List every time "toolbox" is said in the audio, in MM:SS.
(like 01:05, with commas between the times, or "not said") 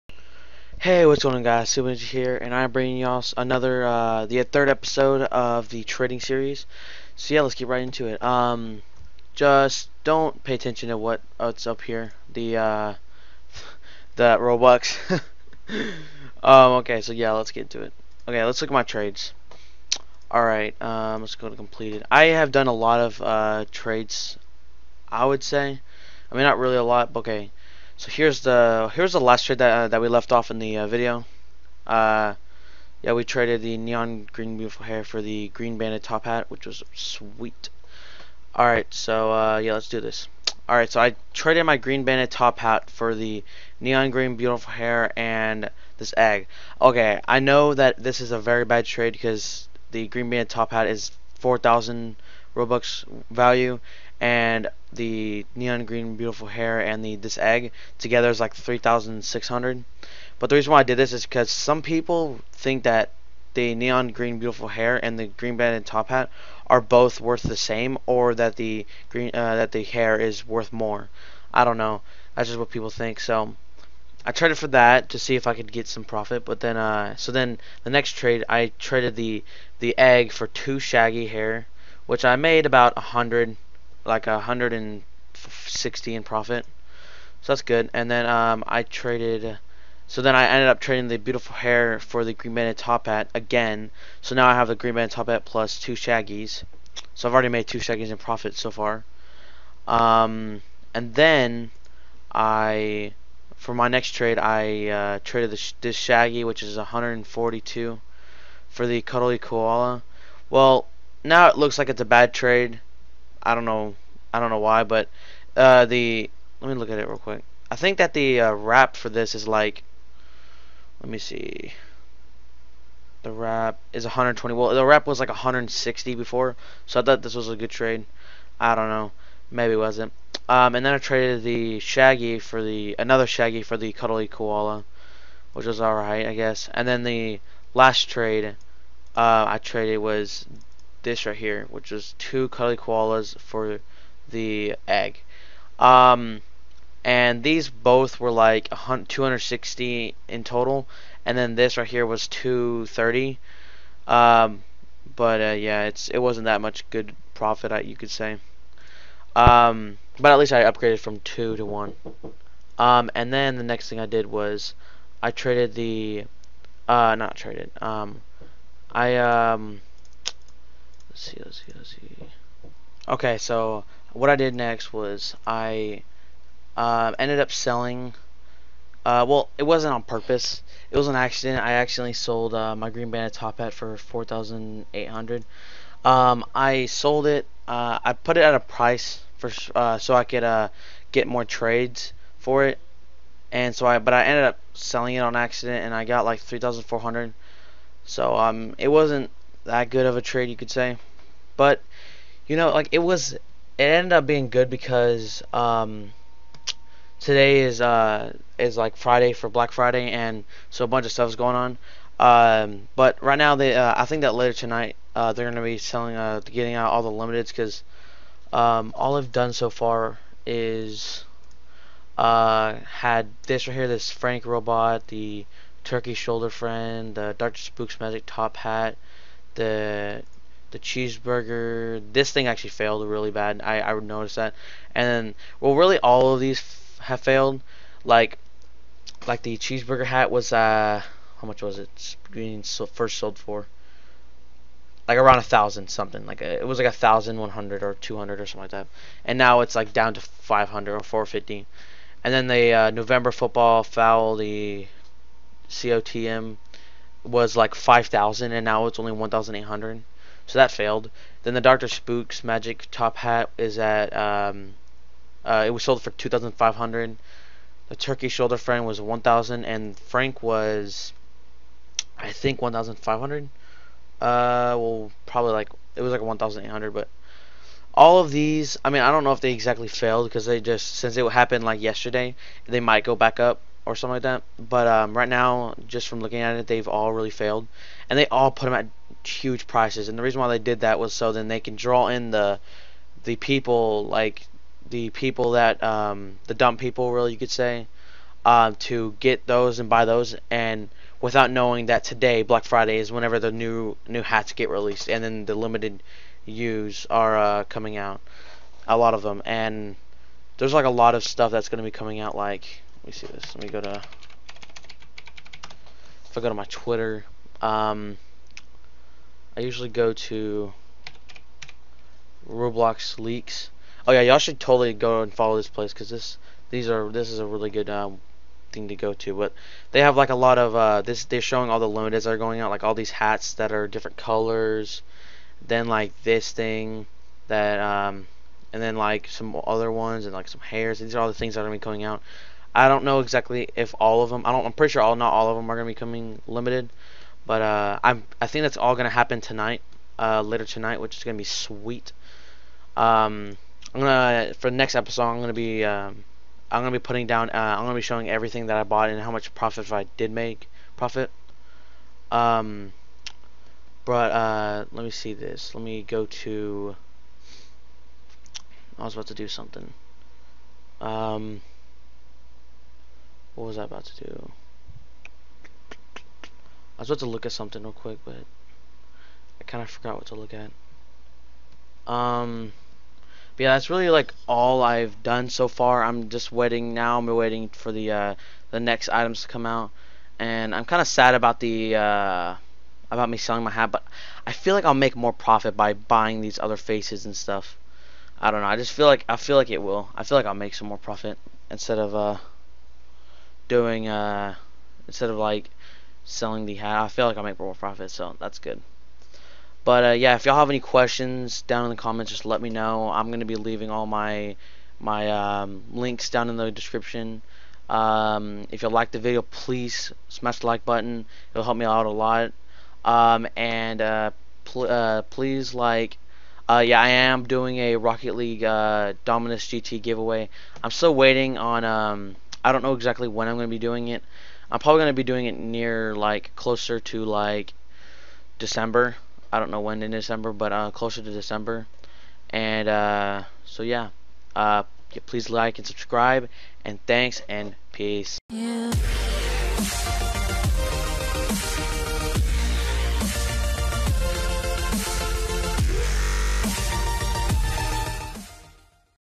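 not said.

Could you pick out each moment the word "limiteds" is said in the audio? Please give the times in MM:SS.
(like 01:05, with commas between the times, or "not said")
03:37, 05:05, 05:31, 05:46.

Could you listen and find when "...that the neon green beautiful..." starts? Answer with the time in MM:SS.
01:02.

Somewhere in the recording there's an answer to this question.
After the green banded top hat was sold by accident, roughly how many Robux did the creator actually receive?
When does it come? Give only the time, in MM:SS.
03:16.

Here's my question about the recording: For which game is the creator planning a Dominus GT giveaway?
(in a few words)
Rocket League.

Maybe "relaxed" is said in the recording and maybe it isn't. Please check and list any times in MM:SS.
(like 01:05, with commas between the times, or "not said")
not said.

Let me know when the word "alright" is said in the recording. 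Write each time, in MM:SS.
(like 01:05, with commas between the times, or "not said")
00:20, 02:15.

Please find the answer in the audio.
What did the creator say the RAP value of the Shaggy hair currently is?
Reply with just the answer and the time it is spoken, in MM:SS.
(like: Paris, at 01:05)
120, at 02:03.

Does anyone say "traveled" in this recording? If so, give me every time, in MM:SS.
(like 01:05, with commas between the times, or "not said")
not said.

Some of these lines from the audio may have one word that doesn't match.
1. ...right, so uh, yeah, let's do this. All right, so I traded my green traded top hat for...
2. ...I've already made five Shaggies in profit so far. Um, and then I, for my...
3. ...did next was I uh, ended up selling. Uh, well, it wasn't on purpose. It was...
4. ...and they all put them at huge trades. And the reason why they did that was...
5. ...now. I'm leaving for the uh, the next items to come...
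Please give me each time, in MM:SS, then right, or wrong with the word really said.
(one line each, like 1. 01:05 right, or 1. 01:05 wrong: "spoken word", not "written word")
1. 00:38 wrong: "banded", not "traded"
2. 01:37 wrong: "two", not "five"
3. 02:54 right
4. 04:48 wrong: "prices", not "trades"
5. 06:26 wrong: "waiting", not "leaving".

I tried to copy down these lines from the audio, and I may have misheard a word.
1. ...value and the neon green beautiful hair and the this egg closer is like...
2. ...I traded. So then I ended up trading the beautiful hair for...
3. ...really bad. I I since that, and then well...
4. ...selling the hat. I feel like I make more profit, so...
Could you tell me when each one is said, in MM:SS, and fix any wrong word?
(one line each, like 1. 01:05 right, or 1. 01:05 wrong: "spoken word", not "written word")
1. 00:53 wrong: "together", not "closer"
2. 01:28 right
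3. 03:53 wrong: "notice", not "since"
4. 06:46 right.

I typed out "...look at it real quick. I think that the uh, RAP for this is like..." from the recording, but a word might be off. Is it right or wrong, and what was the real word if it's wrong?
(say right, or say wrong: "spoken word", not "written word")
right.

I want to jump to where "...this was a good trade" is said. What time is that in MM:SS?
02:07.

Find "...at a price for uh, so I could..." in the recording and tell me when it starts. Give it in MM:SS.
03:08.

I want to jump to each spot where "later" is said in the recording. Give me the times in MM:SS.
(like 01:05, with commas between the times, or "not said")
03:34, 05:50.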